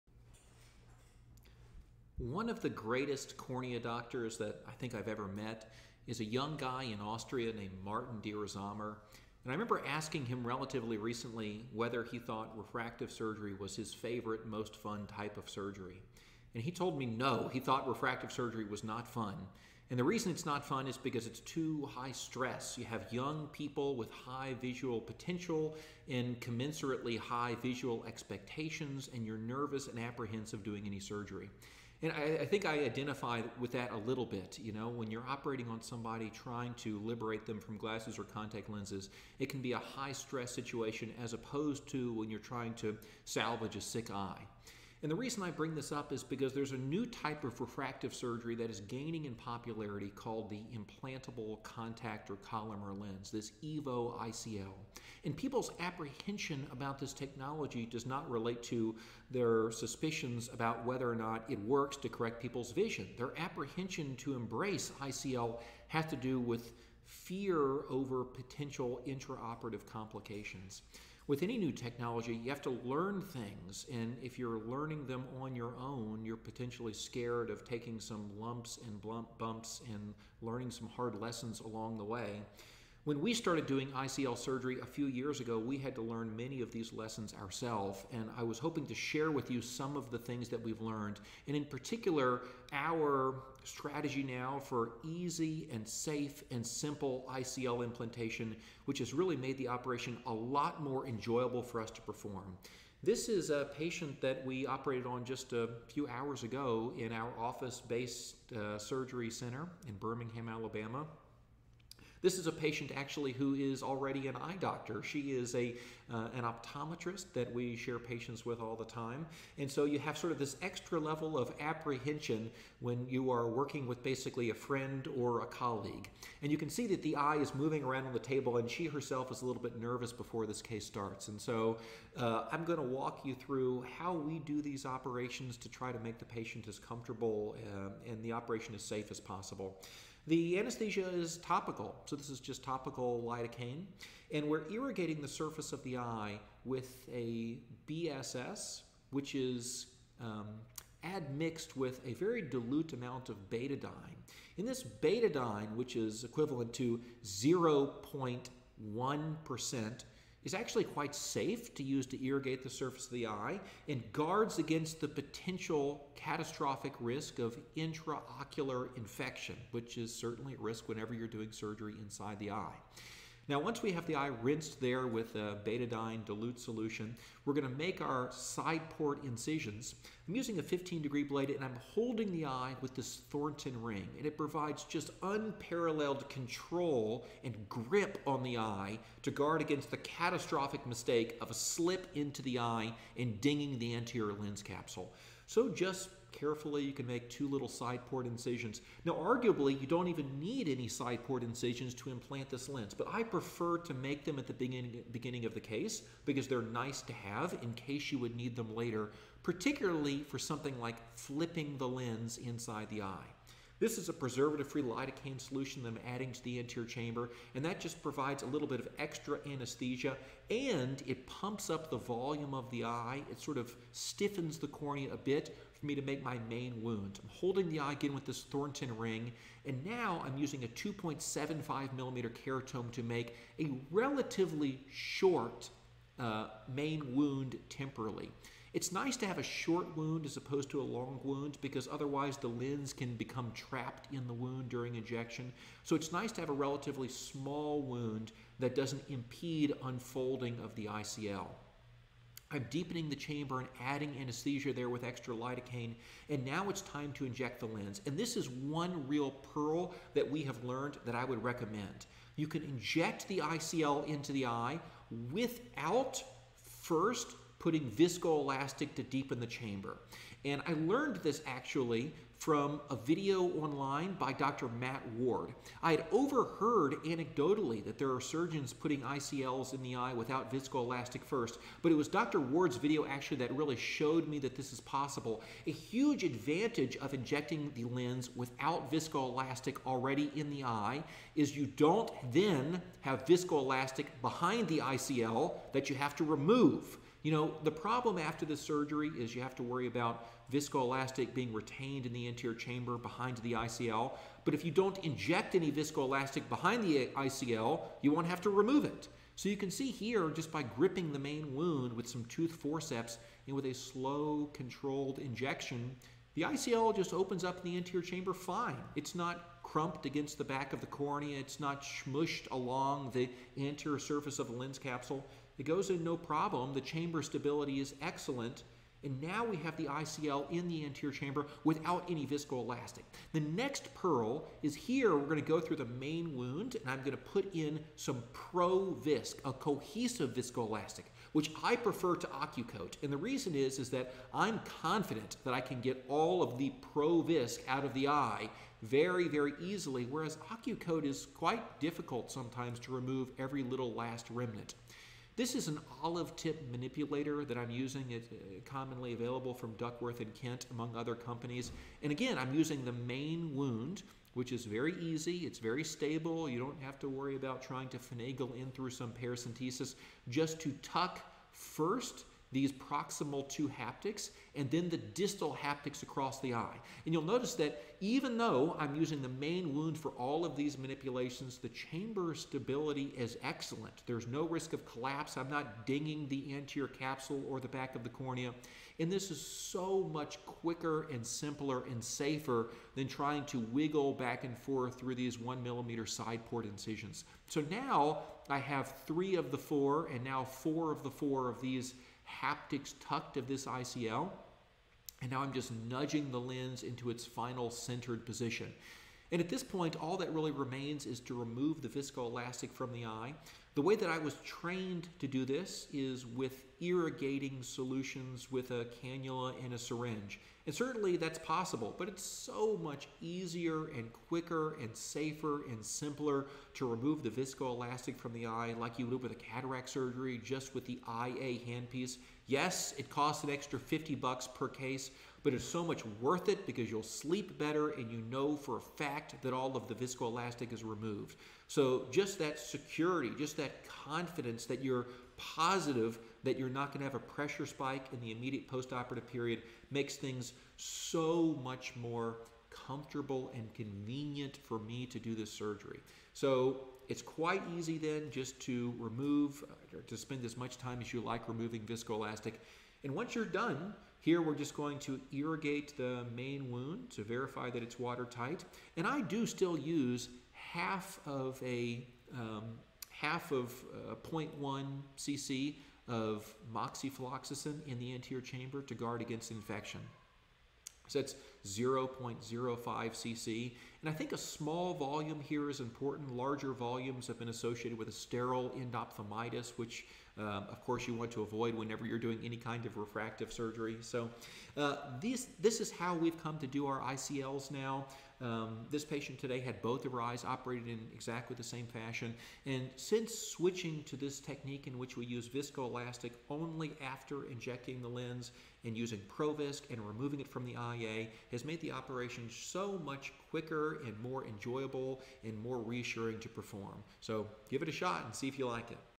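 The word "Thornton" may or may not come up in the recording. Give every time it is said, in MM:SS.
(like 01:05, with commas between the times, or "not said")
03:03, 03:48.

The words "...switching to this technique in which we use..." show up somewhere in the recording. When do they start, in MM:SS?
08:23.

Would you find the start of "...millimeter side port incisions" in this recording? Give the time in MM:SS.
06:35.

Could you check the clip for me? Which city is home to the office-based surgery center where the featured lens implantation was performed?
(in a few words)
Birmingham, Alabama.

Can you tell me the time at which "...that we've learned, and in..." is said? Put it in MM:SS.
01:30.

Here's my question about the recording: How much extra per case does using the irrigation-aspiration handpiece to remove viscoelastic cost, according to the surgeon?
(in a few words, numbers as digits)
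50 bucks.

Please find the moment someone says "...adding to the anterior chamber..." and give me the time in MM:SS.
03:36.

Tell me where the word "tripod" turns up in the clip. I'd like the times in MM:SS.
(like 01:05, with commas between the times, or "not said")
not said.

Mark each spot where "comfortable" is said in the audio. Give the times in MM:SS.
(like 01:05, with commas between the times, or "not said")
02:16, 07:32.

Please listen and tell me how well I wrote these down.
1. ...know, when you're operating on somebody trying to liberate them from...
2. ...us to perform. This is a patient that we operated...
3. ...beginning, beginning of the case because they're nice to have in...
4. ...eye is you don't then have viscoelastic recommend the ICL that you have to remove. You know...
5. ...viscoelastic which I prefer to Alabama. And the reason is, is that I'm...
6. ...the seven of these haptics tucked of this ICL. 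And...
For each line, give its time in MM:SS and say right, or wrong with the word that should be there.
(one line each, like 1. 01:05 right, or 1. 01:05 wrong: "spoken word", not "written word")
1. 00:34 right
2. 01:41 right
3. 03:24 right
4. 04:50 wrong: "behind", not "recommend"
5. 05:40 wrong: "OcuCoat", not "Alabama"
6. 06:41 wrong: "four", not "seven".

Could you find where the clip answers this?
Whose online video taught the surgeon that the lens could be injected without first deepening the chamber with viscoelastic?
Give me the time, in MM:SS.
04:34.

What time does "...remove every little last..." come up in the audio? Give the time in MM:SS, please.
05:52.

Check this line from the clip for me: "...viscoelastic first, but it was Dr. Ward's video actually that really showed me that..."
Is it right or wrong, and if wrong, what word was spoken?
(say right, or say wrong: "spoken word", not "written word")
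right.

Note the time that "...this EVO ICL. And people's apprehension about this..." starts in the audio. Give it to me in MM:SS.
00:53.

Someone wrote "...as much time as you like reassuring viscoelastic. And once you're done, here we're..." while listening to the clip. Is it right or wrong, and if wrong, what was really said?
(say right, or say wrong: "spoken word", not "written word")
wrong: "removing", not "reassuring".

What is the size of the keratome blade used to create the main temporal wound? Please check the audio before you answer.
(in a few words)
2.75 millimeter.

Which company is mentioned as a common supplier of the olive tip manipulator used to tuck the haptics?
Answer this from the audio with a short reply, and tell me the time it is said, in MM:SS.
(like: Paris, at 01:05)
Duckworth and Kent, at 05:59.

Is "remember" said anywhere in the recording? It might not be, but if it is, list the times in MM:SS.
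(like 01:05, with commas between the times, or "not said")
00:09.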